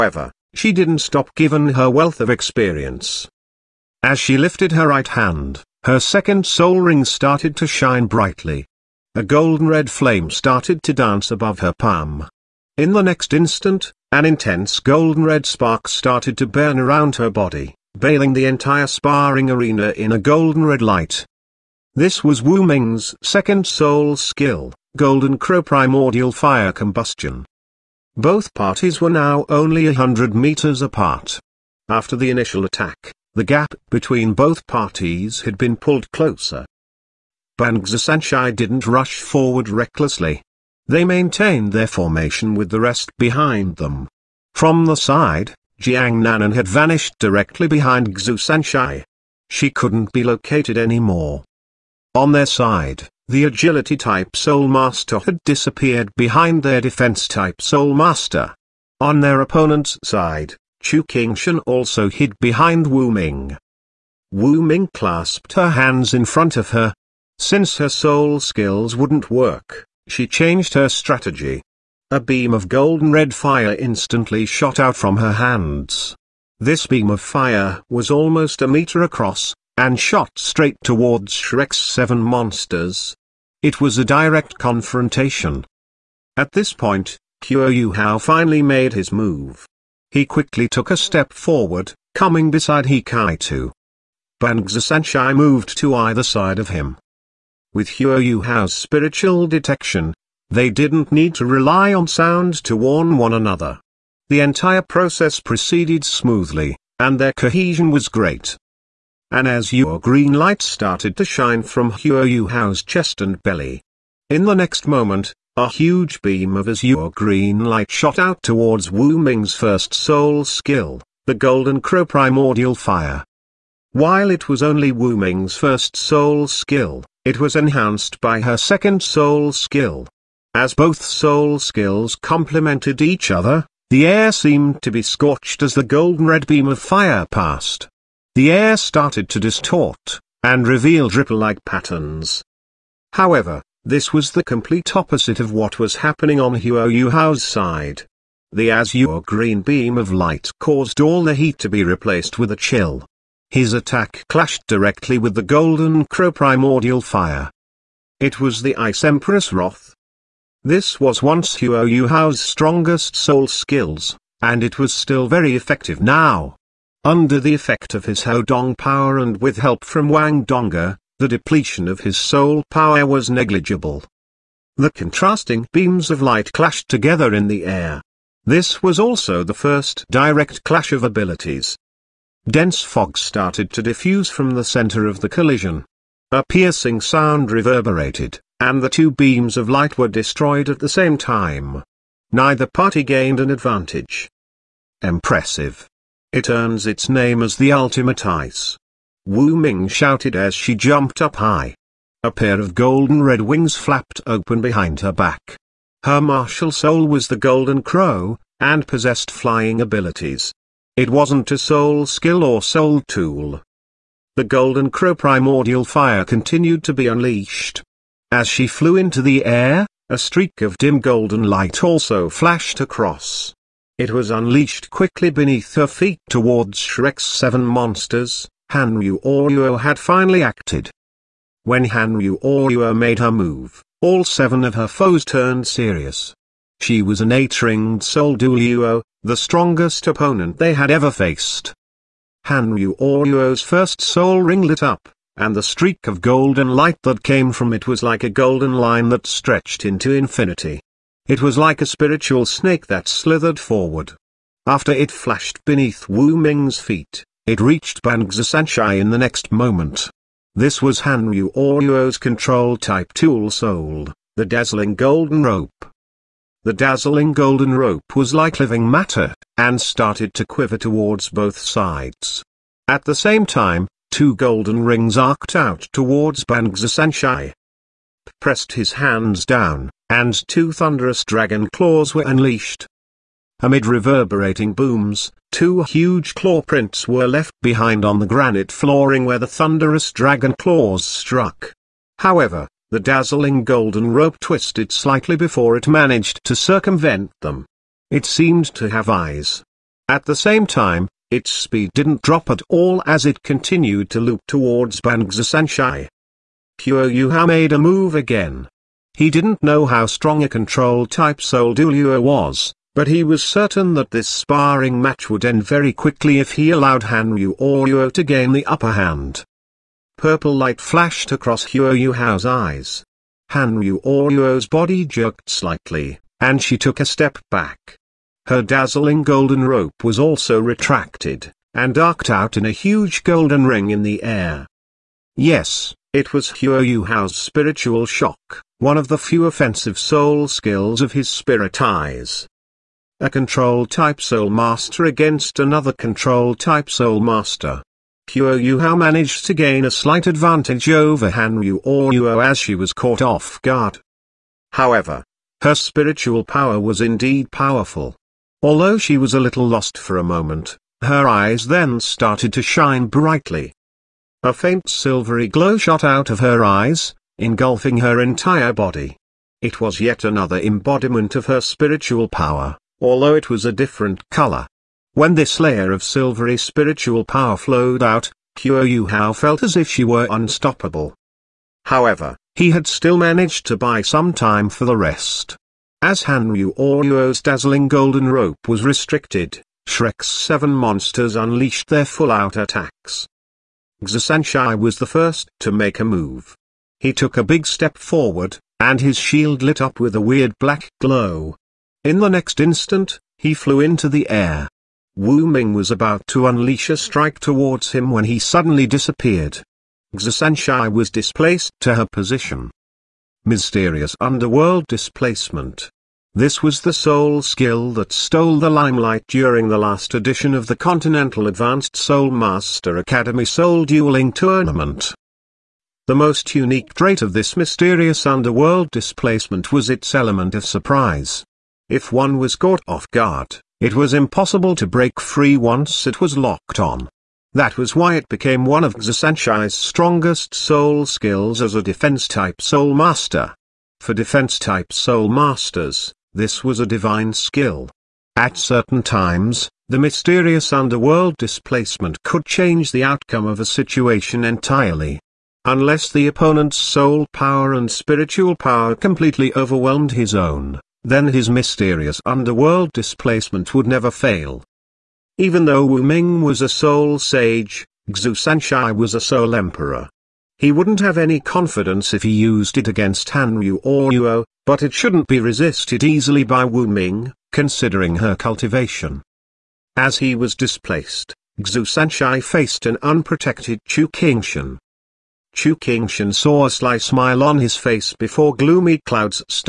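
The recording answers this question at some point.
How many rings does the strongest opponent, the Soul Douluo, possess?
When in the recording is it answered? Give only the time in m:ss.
3:57.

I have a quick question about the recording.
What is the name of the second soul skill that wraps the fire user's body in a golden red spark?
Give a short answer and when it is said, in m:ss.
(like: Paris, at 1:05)
Golden Crow Primordial Fire Combustion, at 0:24.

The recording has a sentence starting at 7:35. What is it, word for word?
Unless the opponent's soul power and spiritual power completely overwhelmed his own, then his mysterious underworld displacement would never fail.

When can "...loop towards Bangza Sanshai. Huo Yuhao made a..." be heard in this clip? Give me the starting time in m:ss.
5:04.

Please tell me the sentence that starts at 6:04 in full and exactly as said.
A faint silvery glow shot out of her eyes, engulfing her entire body.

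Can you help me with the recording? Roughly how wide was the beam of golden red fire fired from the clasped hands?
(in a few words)
1 meter.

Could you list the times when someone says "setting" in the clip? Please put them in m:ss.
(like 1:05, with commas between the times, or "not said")
not said.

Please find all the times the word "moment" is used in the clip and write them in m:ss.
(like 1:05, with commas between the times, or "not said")
1:54, 4:19, 6:00.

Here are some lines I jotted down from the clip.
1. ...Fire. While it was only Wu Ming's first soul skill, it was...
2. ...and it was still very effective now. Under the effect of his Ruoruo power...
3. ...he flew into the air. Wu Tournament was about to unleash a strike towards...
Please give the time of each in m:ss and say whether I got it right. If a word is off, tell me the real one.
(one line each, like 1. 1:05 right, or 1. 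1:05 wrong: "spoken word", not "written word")
1. 2:02 right
2. 2:44 wrong: "Haodong", not "Ruoruo"
3. 6:43 wrong: "Ming", not "Tournament".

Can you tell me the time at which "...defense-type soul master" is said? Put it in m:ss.
7:21.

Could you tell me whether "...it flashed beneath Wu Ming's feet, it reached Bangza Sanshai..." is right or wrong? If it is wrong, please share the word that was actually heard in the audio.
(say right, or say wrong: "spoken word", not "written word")
right.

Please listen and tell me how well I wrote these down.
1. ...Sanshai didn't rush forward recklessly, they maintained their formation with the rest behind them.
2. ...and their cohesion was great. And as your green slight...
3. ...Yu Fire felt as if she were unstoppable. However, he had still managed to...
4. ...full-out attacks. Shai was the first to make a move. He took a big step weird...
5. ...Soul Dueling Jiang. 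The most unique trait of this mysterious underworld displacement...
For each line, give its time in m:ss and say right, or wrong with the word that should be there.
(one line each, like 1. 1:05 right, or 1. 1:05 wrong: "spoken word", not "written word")
1. 0:37 right
2. 1:46 wrong: "light", not "slight"
3. 6:18 wrong: "Hao", not "Fire"
4. 6:32 wrong: "forward", not "weird"
5. 7:03 wrong: "Tournament", not "Jiang".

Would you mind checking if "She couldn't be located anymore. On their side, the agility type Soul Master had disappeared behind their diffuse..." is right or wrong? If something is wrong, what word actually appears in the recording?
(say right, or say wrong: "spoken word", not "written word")
wrong: "defense", not "diffuse".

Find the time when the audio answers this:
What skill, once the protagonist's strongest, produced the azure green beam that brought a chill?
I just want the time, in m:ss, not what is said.
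2:38.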